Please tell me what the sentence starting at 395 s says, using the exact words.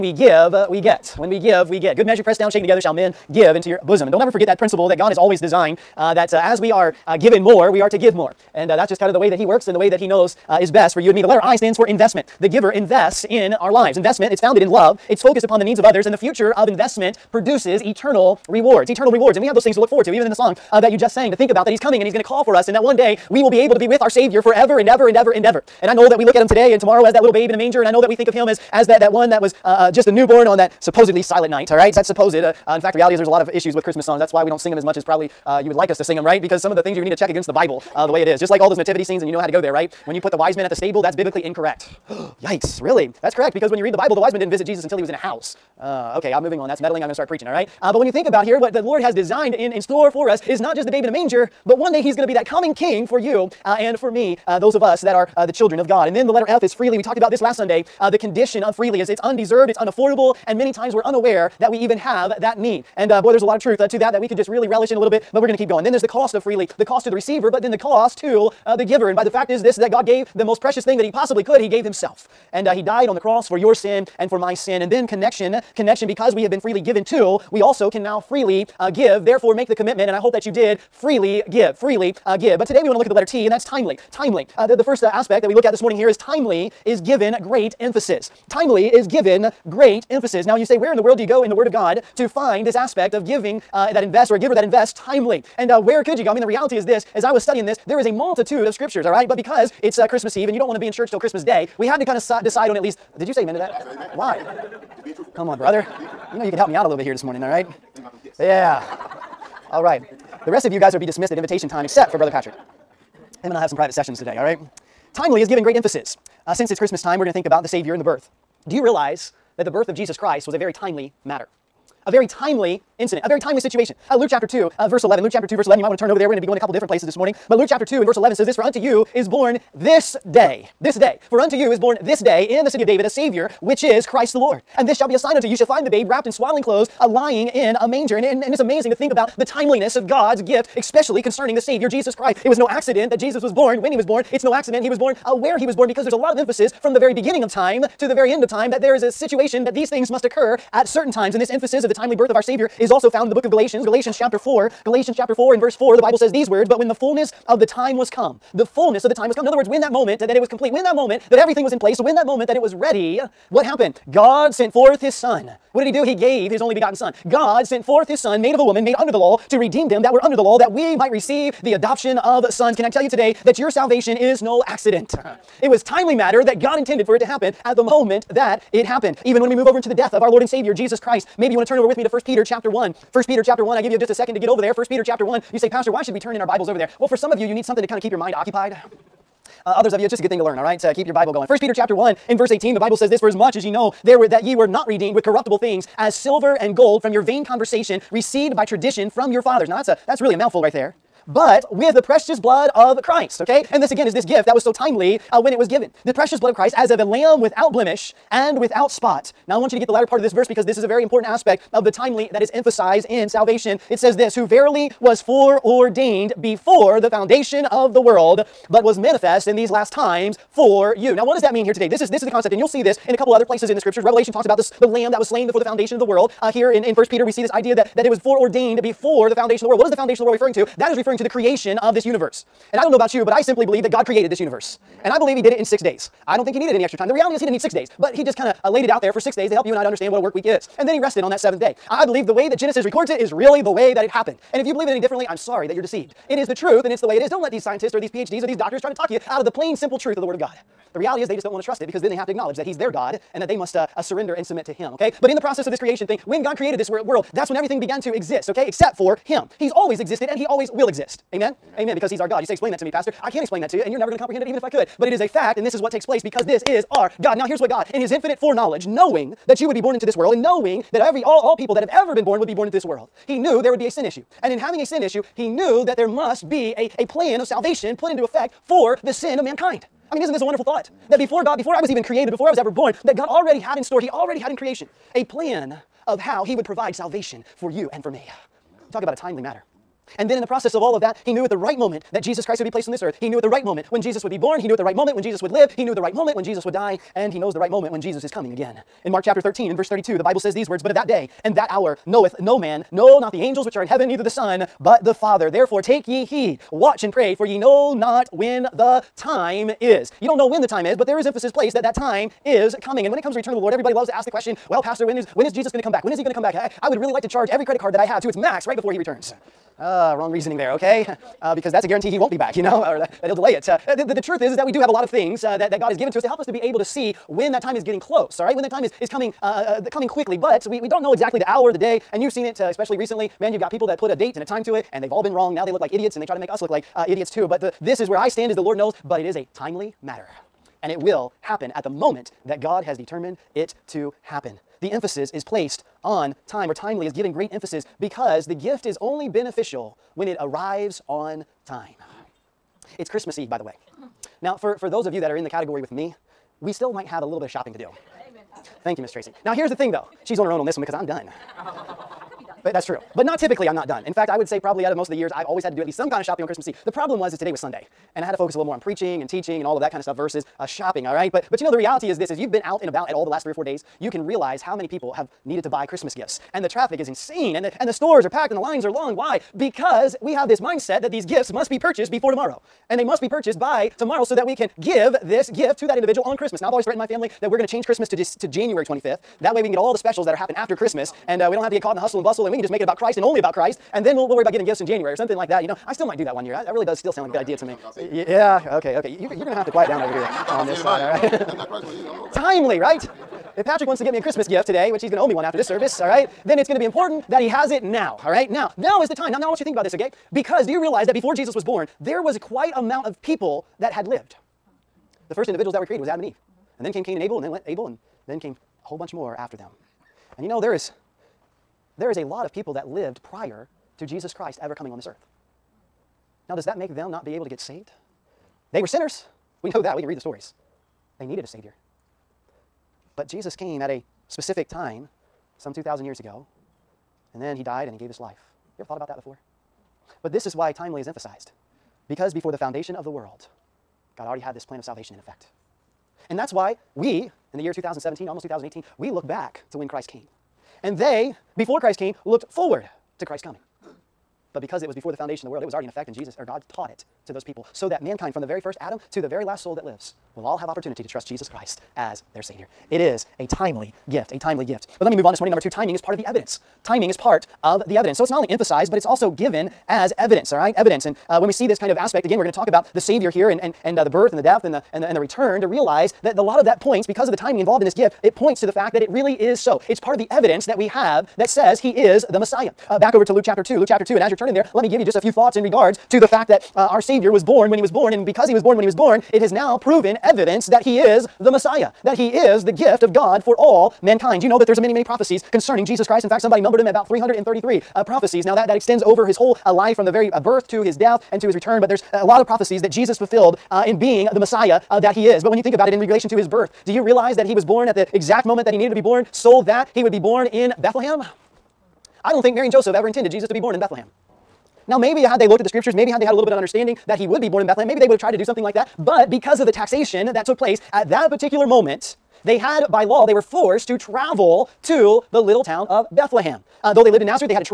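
You know, I still might do that one year.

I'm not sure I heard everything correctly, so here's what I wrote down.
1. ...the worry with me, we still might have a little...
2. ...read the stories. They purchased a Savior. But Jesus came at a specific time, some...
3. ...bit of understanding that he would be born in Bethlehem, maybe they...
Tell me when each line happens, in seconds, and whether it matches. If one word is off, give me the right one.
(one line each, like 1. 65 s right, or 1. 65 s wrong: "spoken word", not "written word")
1. 355 s wrong: "category", not "worry"
2. 430 s wrong: "needed", not "purchased"
3. 516 s right.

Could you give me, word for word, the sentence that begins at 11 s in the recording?
The letter I stands for investment.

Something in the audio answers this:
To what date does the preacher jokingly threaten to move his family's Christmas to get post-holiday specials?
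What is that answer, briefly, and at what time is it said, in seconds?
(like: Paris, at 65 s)
January 25th, at 388 s.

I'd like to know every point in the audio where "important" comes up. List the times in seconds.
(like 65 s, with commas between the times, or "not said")
211 s, 406 s.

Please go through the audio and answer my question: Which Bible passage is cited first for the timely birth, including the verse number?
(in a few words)
Luke 2:11.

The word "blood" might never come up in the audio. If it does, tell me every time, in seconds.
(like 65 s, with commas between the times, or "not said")
202 s, 206 s.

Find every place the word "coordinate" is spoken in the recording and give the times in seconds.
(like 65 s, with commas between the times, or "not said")
not said.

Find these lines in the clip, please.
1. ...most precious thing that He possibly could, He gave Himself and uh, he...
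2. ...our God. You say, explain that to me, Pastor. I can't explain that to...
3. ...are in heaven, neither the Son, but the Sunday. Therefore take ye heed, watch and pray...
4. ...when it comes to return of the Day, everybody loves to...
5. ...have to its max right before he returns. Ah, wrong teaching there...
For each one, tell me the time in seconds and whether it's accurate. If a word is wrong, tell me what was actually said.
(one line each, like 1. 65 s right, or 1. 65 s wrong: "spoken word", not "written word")
1. 70 s right
2. 262 s right
3. 303 s wrong: "Father", not "Sunday"
4. 313 s wrong: "Lord", not "Day"
5. 318 s wrong: "reasoning", not "teaching".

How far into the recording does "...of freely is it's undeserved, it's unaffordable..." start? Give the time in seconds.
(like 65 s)
58 s.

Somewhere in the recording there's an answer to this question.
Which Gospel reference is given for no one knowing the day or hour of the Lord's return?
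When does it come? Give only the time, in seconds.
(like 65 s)
299 s.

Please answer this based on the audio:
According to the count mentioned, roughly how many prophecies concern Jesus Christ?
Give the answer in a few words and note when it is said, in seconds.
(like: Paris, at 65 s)
333, at 497 s.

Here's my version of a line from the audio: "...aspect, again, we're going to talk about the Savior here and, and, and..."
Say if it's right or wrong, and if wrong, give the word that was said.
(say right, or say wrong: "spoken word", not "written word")
right.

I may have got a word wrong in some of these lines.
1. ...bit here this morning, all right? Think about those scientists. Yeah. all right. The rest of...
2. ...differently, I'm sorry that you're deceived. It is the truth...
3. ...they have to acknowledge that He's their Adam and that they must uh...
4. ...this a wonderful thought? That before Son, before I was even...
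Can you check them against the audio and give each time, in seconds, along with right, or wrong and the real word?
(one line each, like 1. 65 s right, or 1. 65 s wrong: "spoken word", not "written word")
1. 106 s wrong: "gifts", not "scientists"
2. 244 s right
3. 252 s wrong: "God", not "Adam"
4. 280 s wrong: "God", not "Son".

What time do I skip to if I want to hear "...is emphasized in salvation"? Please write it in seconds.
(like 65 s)
212 s.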